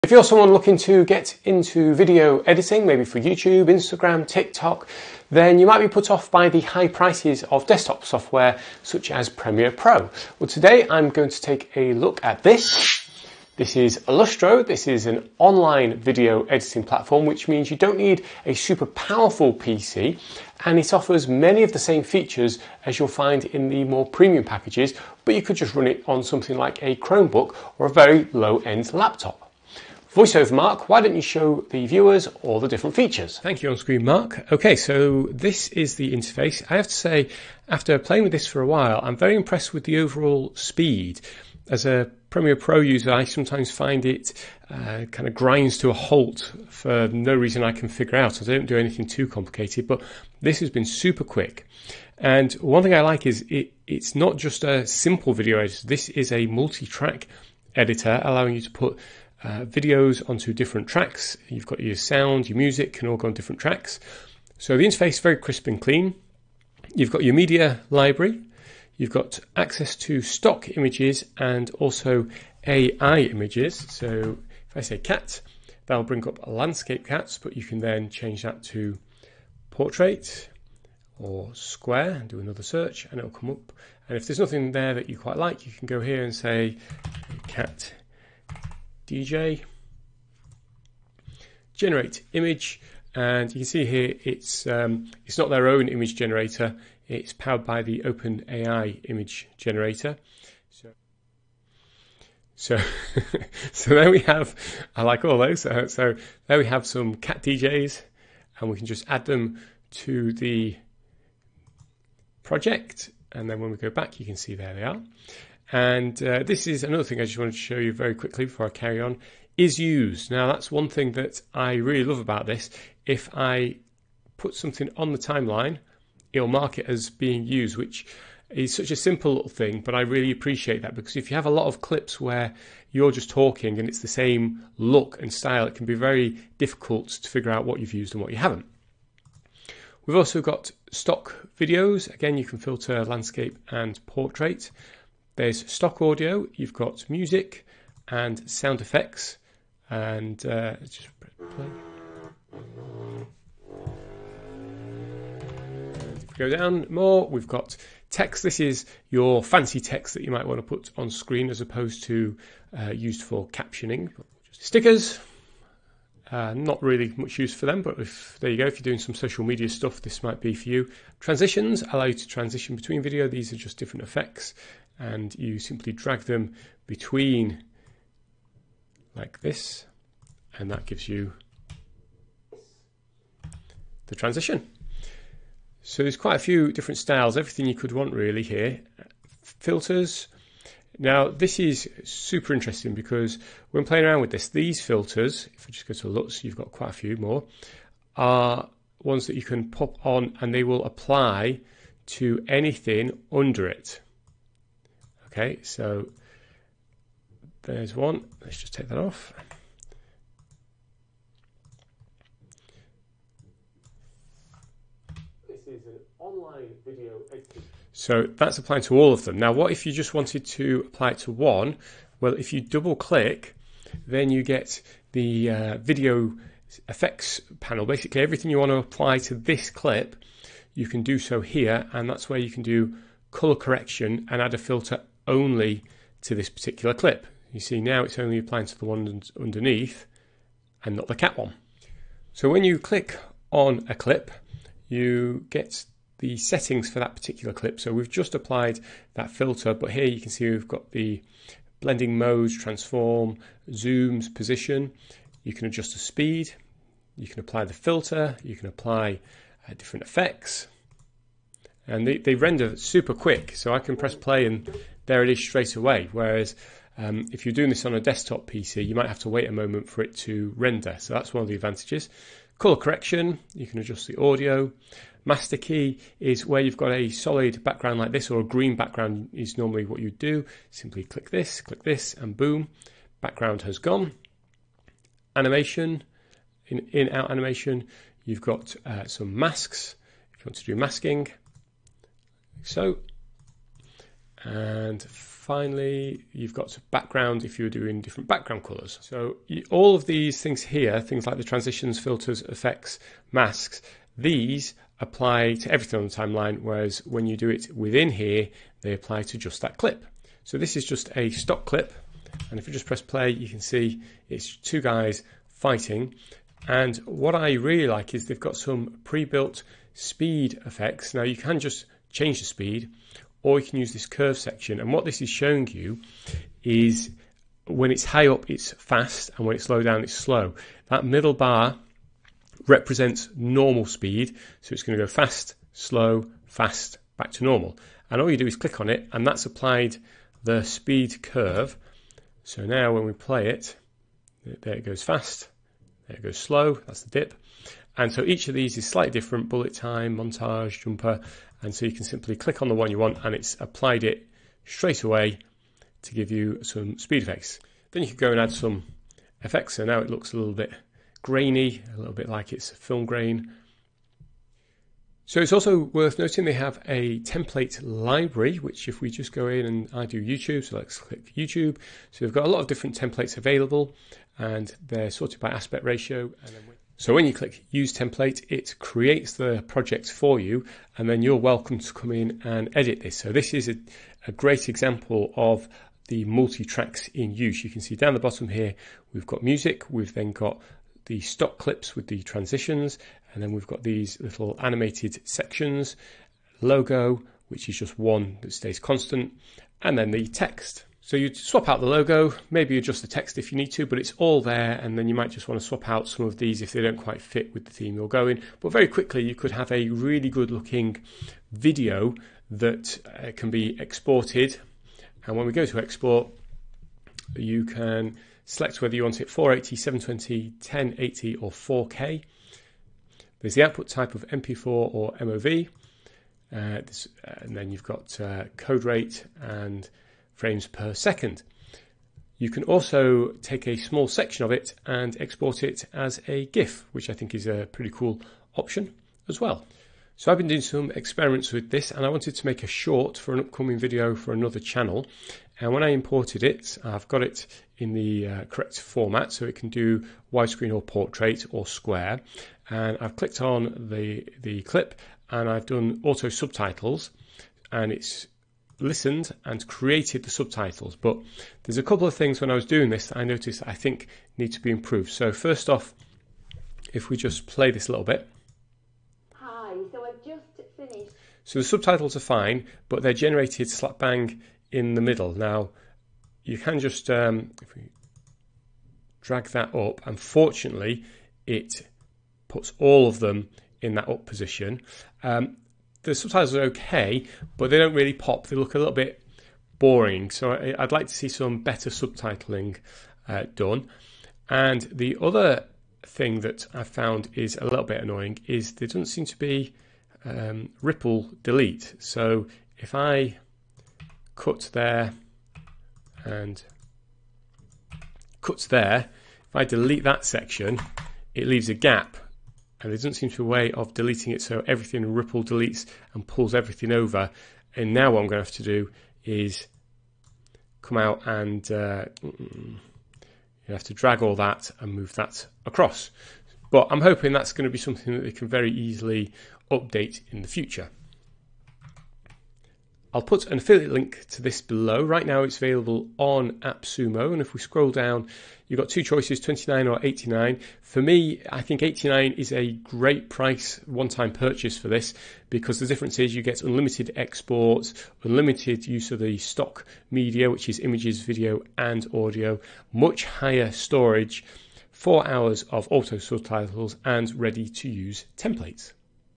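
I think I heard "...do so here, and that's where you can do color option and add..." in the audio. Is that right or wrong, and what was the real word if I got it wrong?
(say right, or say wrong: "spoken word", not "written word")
wrong: "correction", not "option".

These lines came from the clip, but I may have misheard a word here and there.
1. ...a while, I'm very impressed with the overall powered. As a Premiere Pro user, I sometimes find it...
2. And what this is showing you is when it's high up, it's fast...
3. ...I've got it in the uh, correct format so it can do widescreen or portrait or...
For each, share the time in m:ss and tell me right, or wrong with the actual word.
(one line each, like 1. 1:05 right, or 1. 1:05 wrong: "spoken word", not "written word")
1. 0:38 wrong: "speed", not "powered"
2. 5:24 right
3. 7:26 right.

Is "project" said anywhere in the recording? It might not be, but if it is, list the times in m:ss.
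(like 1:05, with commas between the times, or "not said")
1:52, 6:19.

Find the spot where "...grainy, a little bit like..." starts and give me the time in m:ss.
6:01.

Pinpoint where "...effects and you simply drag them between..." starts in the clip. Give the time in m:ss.
2:54.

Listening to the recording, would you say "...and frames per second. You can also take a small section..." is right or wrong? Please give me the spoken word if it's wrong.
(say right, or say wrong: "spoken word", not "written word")
right.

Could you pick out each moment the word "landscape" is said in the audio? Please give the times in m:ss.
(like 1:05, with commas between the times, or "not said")
1:16, 2:23.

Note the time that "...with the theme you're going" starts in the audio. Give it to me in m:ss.
6:47.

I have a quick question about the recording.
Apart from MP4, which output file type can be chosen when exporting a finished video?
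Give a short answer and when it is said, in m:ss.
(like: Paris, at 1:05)
MOV, at 7:05.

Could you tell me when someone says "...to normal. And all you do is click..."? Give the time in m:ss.
5:37.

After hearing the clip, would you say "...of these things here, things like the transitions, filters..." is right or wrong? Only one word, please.
right.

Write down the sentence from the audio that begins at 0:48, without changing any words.
I don't do anything too complicated, but this has been super quick.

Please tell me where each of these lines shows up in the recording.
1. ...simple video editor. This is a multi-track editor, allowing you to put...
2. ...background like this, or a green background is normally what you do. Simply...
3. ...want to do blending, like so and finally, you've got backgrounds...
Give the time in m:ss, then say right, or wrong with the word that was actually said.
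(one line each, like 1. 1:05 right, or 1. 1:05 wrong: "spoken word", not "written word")
1. 0:54 right
2. 4:37 right
3. 4:50 wrong: "masking", not "blending".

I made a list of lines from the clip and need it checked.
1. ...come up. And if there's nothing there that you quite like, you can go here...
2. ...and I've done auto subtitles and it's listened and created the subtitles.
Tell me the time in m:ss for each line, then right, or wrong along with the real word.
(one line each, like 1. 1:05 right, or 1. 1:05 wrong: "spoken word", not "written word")
1. 1:23 right
2. 7:35 right.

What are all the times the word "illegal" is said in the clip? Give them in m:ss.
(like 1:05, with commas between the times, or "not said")
not said.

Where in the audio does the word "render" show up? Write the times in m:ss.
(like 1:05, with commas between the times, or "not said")
4:22, 4:30.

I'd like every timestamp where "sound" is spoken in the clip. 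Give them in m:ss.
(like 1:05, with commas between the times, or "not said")
1:01, 2:28.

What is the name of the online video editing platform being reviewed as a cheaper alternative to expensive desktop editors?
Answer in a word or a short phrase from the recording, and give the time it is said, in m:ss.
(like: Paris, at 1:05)
Illusto, at 0:14.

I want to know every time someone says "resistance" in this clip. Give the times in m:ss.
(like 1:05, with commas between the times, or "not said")
not said.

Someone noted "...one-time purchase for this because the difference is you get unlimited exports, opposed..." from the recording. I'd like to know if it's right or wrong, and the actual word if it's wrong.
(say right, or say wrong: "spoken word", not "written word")
wrong: "unlimited", not "opposed".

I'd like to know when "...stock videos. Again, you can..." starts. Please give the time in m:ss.
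2:20.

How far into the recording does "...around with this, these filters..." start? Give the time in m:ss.
3:14.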